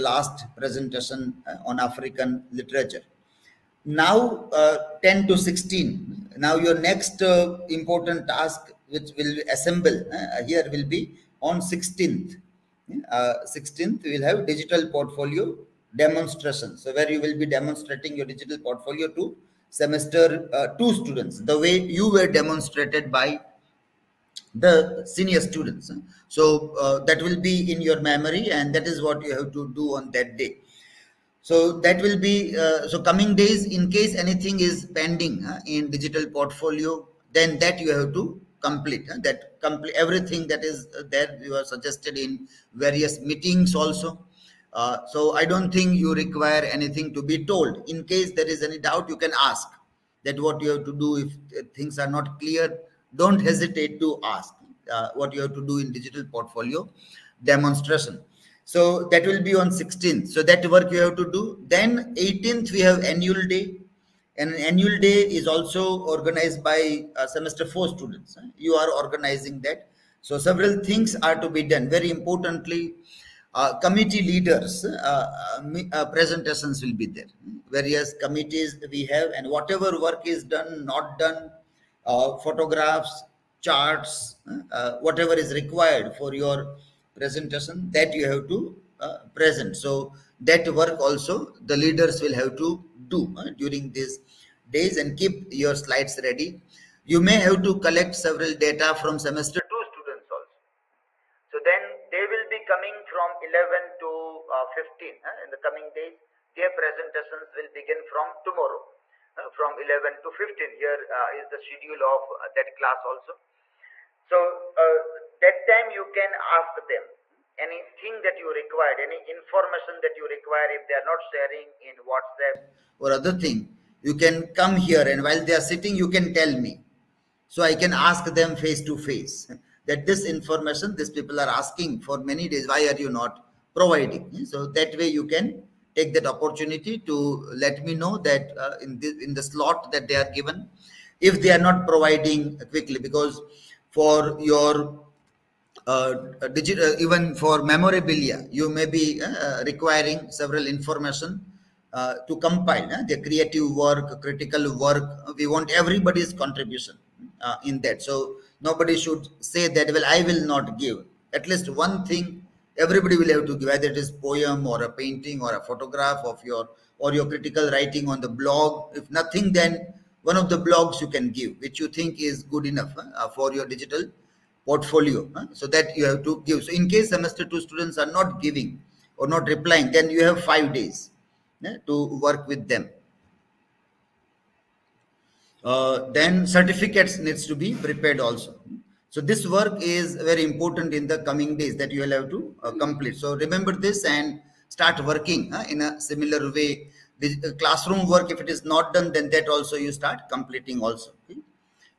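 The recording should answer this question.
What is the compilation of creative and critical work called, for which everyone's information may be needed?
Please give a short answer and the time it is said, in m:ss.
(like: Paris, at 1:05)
Memorabilia, at 2:27.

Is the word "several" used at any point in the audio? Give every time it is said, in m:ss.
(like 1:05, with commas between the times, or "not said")
1:10, 1:38, 2:30.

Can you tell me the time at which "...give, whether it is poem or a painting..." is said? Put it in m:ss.
2:43.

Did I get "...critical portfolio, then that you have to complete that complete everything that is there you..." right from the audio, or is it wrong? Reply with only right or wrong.
wrong.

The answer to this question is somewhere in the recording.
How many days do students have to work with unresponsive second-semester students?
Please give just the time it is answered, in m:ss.
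3:00.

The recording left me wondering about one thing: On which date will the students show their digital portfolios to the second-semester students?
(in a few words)
16th.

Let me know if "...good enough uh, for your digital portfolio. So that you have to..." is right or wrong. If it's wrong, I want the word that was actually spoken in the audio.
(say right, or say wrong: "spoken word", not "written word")
right.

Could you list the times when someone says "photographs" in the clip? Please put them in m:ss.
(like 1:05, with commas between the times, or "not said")
1:22, 2:45.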